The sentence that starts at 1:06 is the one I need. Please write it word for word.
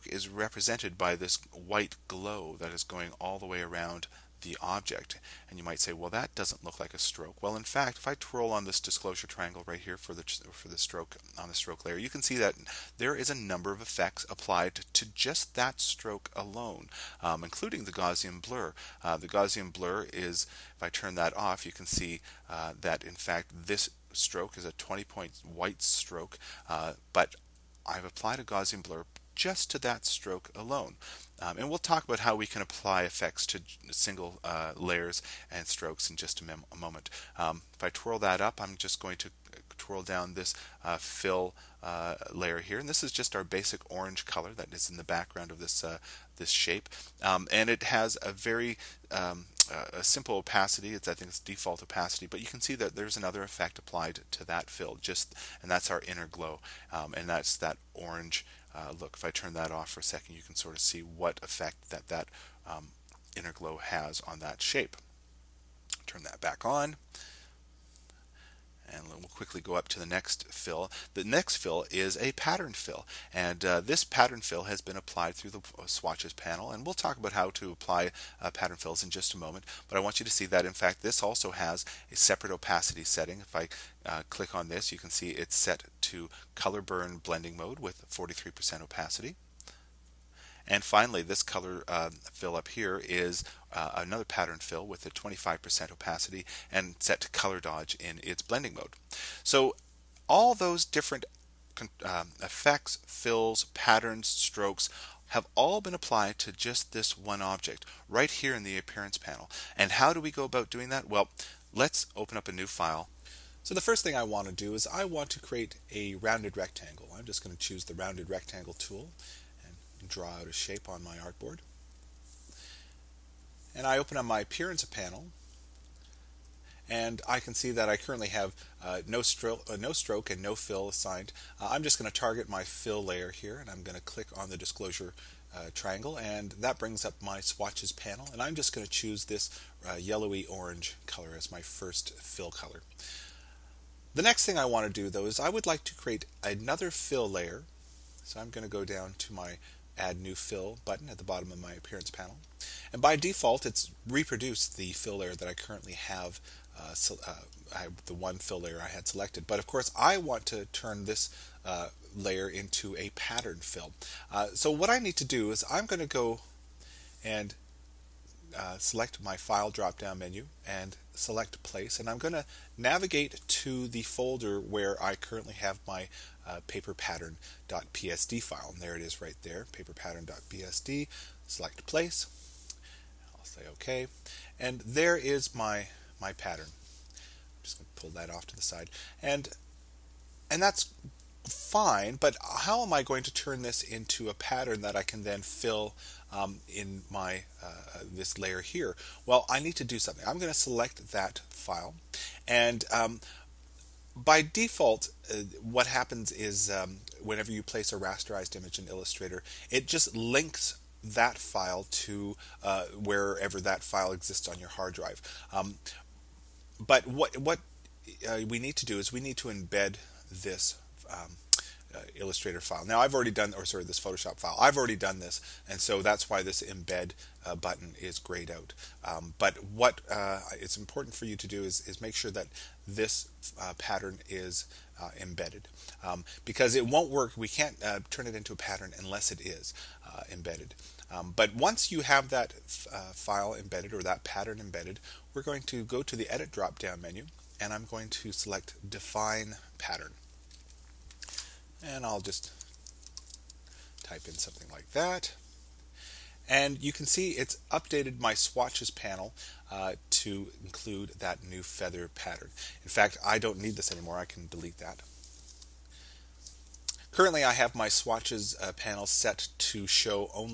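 Turn that back on and we'll quickly go up to the next fill.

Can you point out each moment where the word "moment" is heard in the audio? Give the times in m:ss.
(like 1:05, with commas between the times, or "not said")
0:36, 1:19.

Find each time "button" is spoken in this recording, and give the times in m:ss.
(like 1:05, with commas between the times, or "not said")
2:30, 3:47.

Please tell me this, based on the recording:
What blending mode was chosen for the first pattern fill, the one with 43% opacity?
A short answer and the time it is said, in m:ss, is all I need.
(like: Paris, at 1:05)
Color burn, at 1:26.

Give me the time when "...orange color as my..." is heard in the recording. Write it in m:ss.
2:20.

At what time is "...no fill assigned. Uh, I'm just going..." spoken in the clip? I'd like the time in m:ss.
2:10.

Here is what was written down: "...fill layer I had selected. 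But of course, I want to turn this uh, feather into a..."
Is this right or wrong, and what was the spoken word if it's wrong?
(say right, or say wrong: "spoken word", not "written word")
wrong: "layer", not "feather".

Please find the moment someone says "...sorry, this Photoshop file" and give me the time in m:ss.
3:43.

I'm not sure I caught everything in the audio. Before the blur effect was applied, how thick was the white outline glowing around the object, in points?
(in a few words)
20 point.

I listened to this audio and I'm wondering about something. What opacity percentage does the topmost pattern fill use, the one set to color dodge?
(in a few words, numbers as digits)
25%.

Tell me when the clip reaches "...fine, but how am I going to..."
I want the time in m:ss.
3:11.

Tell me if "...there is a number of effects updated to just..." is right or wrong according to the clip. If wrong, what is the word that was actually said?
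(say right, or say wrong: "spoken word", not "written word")
wrong: "applied", not "updated".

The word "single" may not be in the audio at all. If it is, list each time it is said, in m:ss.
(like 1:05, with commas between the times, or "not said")
0:33.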